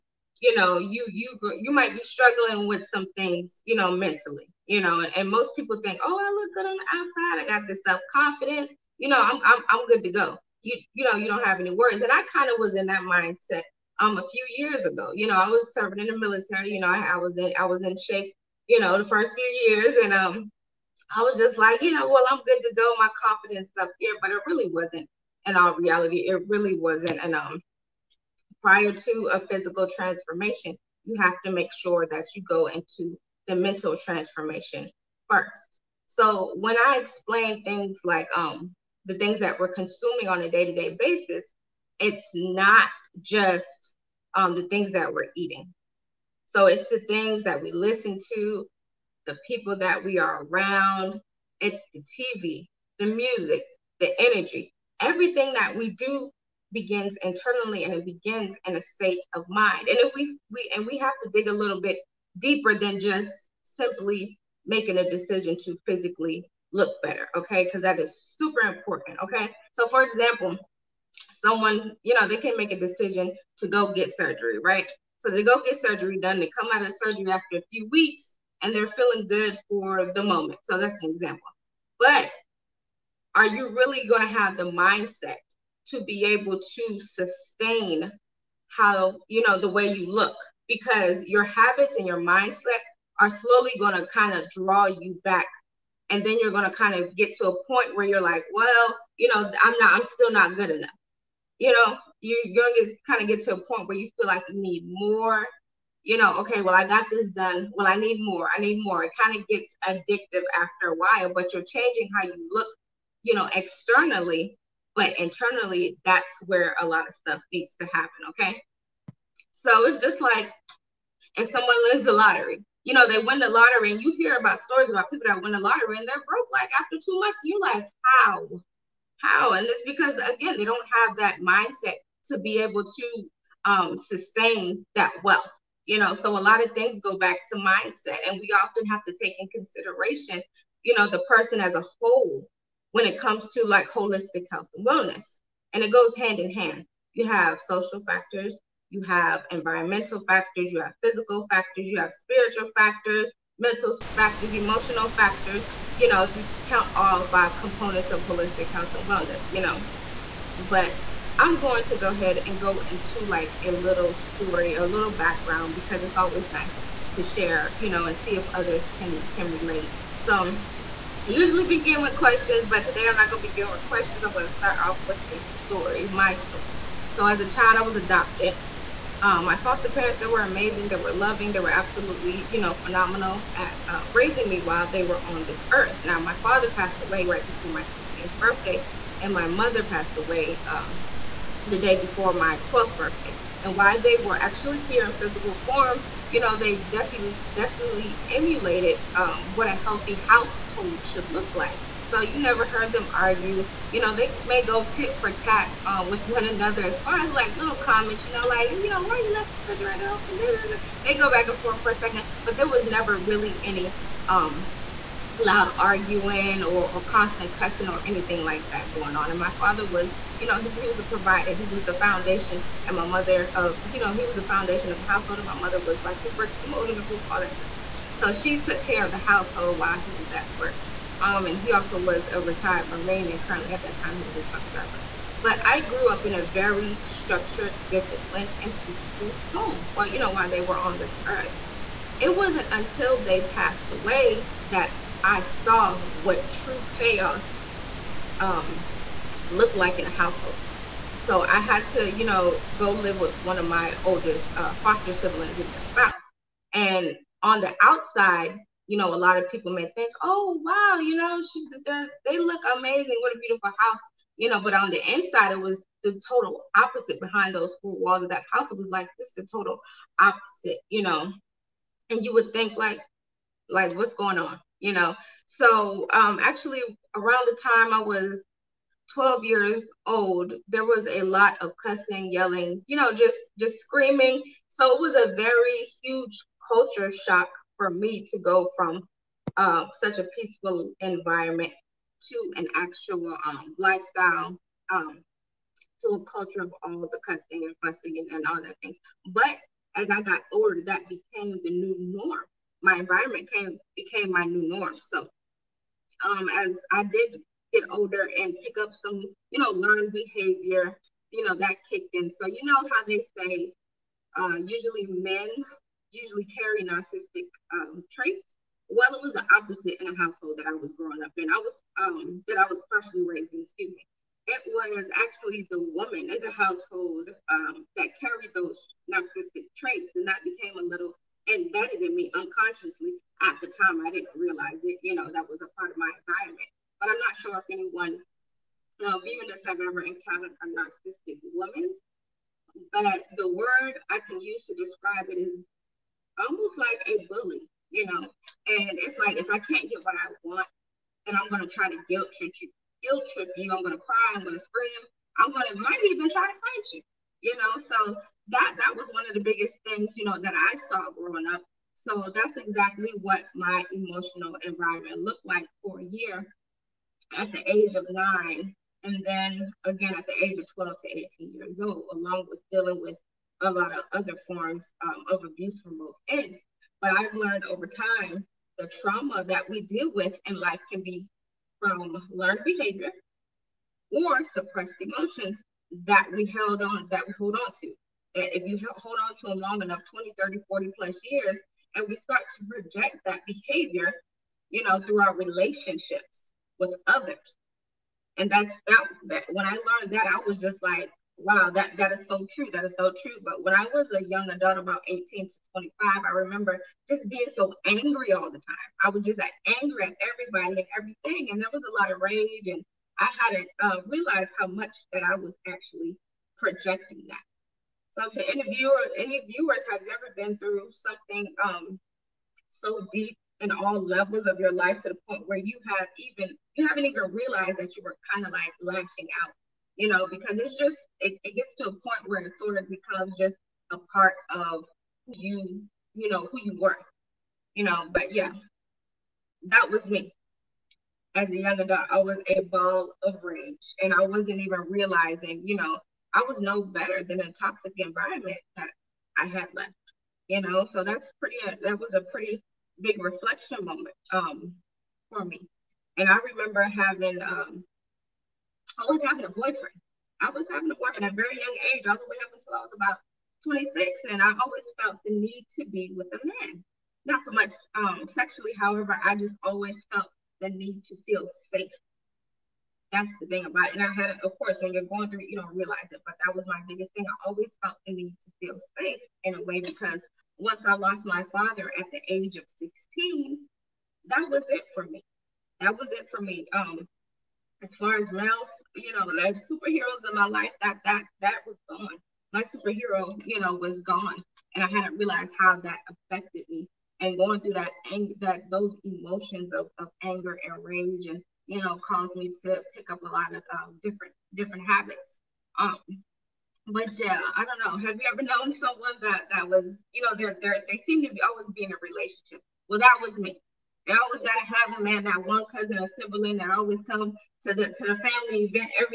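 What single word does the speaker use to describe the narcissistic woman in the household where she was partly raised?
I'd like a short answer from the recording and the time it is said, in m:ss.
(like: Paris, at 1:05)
bully, at 5:47.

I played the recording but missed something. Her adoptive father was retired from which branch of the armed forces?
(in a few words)
Marine.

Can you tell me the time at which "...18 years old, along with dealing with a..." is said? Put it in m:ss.
6:11.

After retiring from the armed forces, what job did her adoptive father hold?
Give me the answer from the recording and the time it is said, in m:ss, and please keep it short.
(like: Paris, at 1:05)
truck driver, at 3:54.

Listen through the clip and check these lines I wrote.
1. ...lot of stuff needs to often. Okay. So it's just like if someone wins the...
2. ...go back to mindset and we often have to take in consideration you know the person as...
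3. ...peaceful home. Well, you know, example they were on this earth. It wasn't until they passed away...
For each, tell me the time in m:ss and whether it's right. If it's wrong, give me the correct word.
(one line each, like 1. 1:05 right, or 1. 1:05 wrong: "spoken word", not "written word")
1. 1:56 wrong: "happen", not "often"
2. 2:17 right
3. 3:58 wrong: "while", not "example".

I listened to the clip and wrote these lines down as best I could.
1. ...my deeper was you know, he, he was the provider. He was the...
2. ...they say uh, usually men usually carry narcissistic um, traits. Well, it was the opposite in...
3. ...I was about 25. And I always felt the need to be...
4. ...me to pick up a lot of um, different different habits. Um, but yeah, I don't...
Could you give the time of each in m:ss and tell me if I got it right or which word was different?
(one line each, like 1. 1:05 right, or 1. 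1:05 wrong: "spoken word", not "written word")
1. 3:39 wrong: "father", not "deeper"
2. 5:13 right
3. 7:42 wrong: "26", not "25"
4. 8:22 right.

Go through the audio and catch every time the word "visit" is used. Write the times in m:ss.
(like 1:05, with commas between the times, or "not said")
not said.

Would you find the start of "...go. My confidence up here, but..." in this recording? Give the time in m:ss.
0:22.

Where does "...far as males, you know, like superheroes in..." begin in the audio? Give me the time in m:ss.
8:07.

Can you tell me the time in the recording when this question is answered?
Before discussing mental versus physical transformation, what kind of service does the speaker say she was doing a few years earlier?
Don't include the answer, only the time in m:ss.
0:16.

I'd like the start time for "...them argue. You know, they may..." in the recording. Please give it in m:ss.
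3:22.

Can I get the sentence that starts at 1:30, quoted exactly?
Because your habits and your mindset are slowly going to kind of draw you back.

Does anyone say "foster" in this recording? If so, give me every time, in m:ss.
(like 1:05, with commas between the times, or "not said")
2:59, 4:14.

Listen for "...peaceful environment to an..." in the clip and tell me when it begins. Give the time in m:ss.
4:50.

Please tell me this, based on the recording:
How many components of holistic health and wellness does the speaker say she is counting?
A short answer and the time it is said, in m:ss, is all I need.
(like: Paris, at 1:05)
5, at 2:37.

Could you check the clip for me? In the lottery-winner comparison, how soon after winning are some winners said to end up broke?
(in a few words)
2 months.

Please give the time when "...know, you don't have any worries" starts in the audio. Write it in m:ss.
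0:11.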